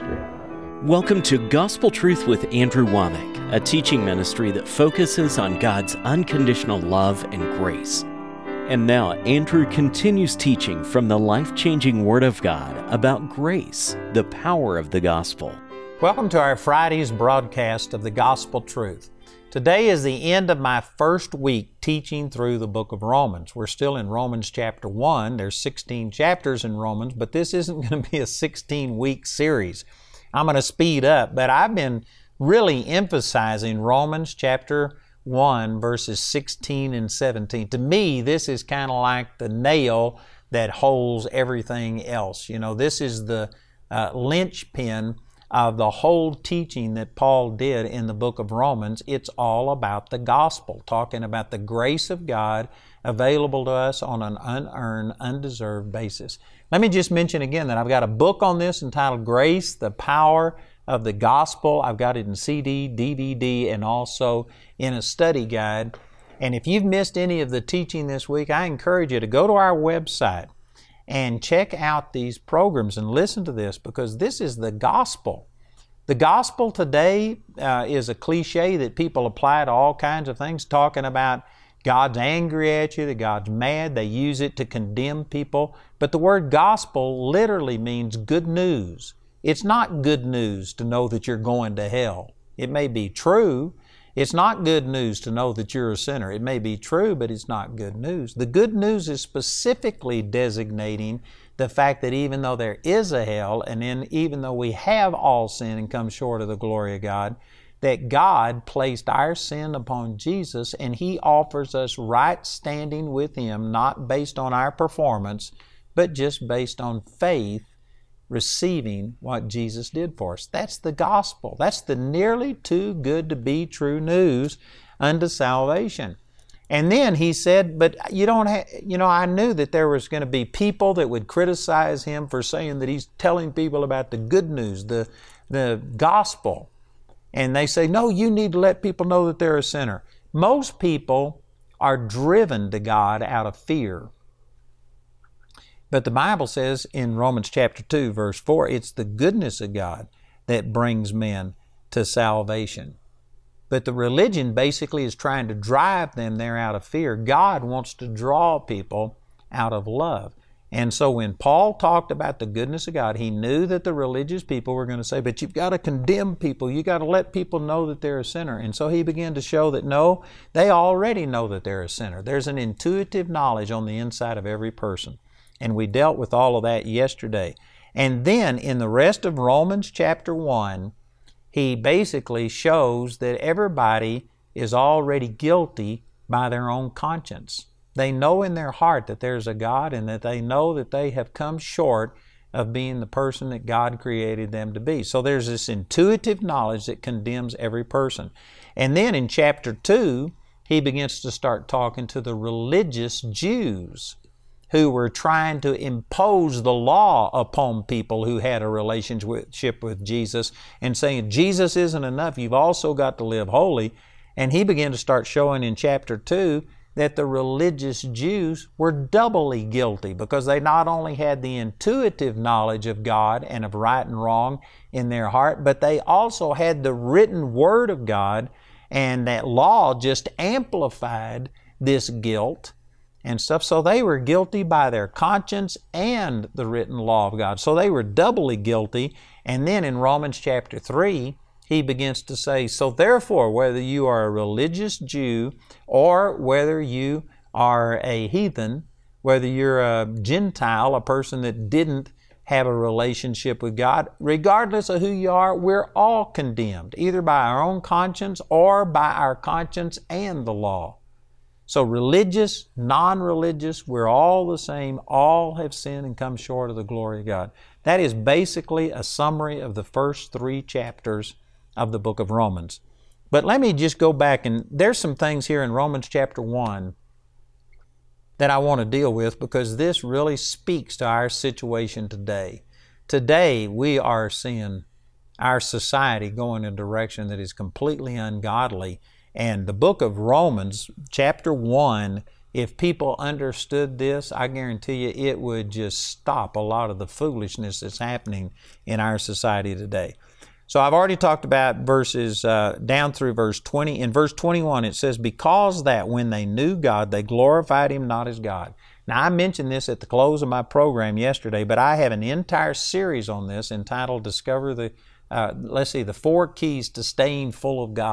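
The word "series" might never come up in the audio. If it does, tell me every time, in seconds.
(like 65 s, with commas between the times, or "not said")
29 s, 312 s.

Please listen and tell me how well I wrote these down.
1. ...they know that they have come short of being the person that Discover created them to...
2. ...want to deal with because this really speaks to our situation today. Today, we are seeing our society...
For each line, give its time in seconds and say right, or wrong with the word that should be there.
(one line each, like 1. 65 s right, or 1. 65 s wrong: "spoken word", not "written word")
1. 190 s wrong: "God", not "Discover"
2. 278 s right.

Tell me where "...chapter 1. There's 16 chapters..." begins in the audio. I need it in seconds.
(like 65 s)
24 s.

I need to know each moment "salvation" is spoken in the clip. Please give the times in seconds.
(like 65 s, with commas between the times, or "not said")
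125 s, 152 s.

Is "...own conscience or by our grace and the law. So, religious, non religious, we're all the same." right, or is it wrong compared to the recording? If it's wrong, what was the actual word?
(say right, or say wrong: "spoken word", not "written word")
wrong: "conscience", not "grace".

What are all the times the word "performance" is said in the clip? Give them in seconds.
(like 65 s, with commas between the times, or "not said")
114 s.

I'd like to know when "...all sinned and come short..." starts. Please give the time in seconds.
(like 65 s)
105 s.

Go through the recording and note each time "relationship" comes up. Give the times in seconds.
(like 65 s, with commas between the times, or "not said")
208 s, 252 s.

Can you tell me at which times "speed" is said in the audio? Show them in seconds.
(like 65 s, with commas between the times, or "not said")
30 s.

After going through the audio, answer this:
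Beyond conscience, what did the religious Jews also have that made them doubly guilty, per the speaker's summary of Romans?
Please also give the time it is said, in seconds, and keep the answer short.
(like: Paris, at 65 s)
The written Word of God, at 226 s.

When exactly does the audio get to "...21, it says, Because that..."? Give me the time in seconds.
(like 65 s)
304 s.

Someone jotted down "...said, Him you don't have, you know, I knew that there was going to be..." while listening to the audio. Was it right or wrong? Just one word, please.
wrong.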